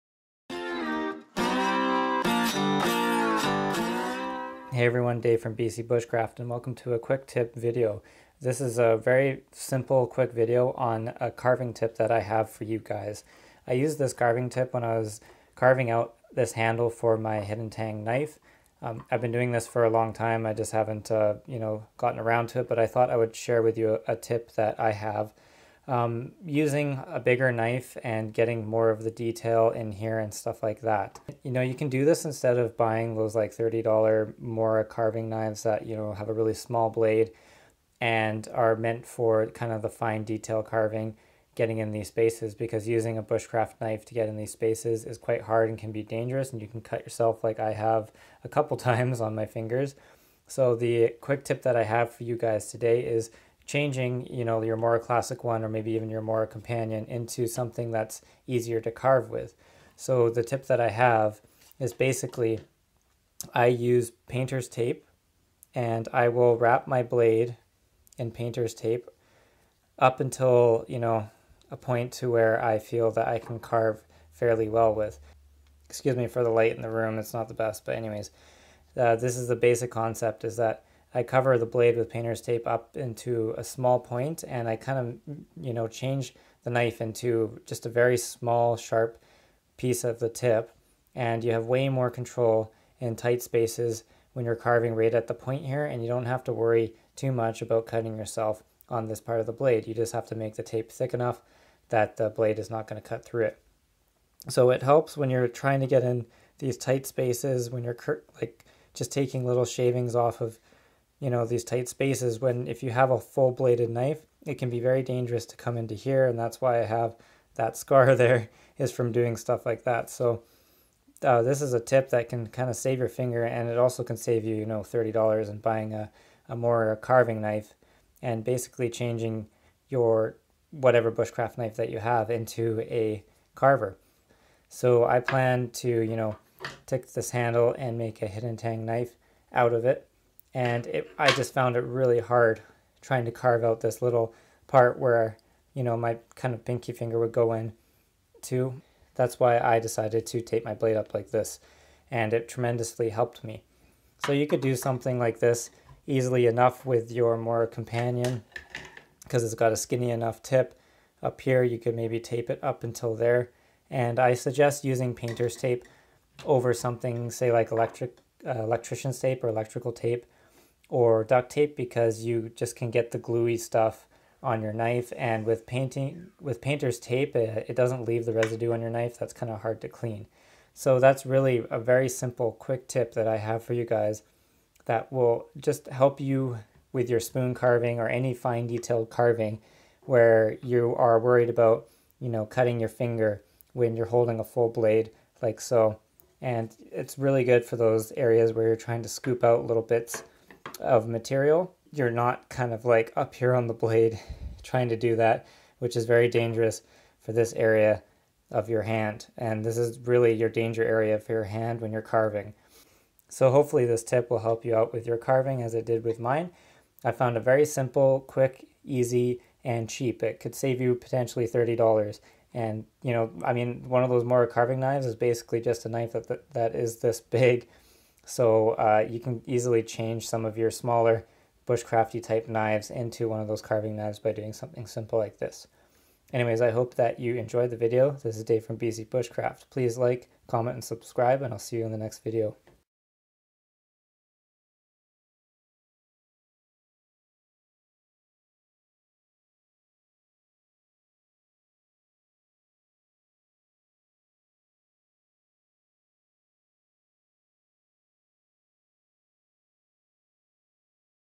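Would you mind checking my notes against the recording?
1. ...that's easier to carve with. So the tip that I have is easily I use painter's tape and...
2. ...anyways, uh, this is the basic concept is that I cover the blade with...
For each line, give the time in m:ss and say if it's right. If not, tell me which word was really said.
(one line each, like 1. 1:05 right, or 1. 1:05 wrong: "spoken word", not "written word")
1. 0:57 wrong: "basically", not "easily"
2. 1:17 right.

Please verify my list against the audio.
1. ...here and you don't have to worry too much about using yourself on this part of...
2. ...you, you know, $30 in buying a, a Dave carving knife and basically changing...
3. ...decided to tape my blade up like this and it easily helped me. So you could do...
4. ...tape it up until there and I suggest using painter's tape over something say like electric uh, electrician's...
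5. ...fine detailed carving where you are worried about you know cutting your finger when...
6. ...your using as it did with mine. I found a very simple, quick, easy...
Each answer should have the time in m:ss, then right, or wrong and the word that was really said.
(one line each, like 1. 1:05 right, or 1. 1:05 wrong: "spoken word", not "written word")
1. 1:35 wrong: "cutting", not "using"
2. 2:04 wrong: "Mora", not "Dave"
3. 2:29 wrong: "tremendously", not "easily"
4. 2:42 right
5. 3:08 right
6. 3:35 wrong: "carving", not "using".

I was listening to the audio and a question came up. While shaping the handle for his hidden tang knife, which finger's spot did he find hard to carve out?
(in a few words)
pinky finger.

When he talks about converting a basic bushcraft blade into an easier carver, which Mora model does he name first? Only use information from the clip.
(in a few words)
Mora classic.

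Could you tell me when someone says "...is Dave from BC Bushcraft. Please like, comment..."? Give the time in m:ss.
3:58.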